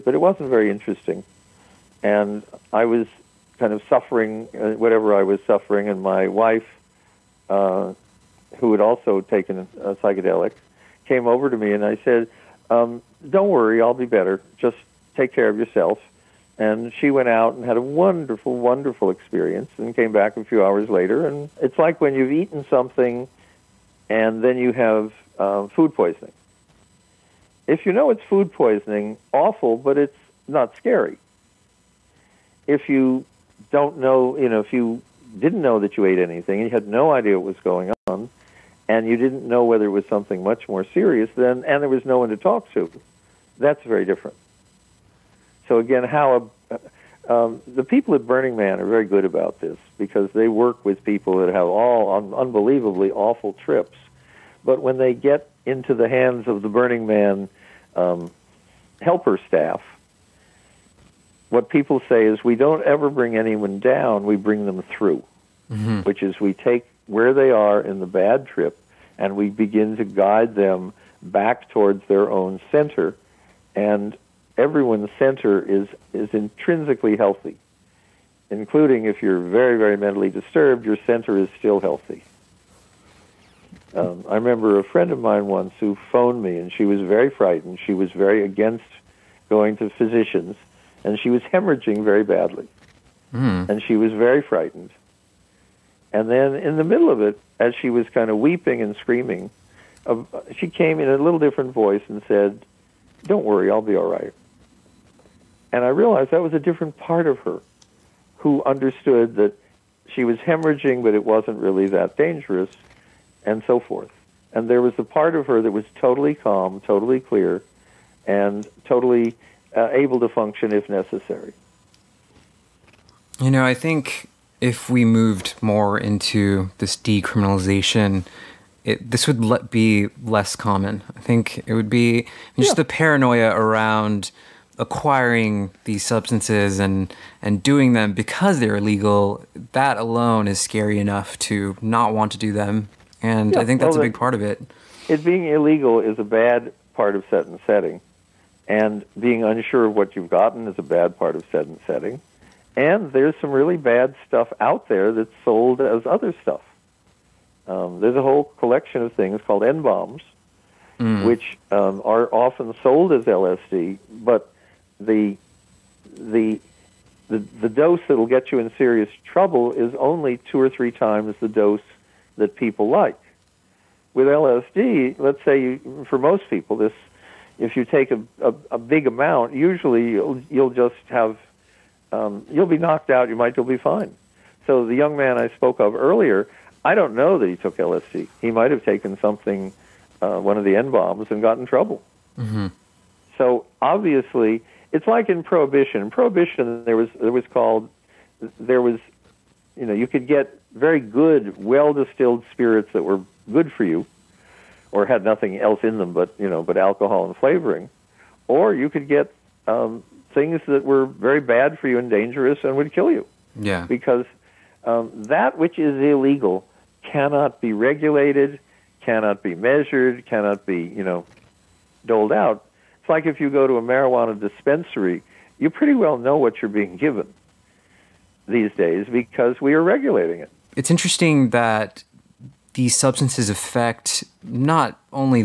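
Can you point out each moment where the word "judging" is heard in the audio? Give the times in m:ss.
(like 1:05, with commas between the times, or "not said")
not said.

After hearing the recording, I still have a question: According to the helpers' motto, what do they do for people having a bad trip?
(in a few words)
Bring them through.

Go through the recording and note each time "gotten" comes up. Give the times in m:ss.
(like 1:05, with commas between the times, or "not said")
2:30.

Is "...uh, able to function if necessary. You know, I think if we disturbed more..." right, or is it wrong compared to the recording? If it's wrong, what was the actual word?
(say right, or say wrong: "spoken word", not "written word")
wrong: "moved", not "disturbed".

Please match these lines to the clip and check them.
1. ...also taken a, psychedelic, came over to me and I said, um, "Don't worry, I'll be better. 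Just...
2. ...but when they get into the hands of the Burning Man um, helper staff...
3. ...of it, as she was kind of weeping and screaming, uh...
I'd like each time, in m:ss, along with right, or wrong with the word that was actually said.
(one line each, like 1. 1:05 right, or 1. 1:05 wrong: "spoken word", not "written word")
1. 0:08 right
2. 0:54 right
3. 1:37 right.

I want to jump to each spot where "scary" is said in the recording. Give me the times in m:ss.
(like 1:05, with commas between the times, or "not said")
0:30, 2:20.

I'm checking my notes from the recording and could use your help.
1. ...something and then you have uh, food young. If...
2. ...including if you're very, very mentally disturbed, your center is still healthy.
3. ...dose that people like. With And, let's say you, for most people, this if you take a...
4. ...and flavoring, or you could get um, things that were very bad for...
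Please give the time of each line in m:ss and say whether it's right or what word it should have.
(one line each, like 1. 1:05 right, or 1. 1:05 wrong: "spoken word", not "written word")
1. 0:22 wrong: "poisoning", not "young"
2. 1:18 right
3. 2:51 wrong: "LSD", not "And"
4. 3:27 right.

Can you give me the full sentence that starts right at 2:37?
Um, there's a whole collection of things called N bombs, mm.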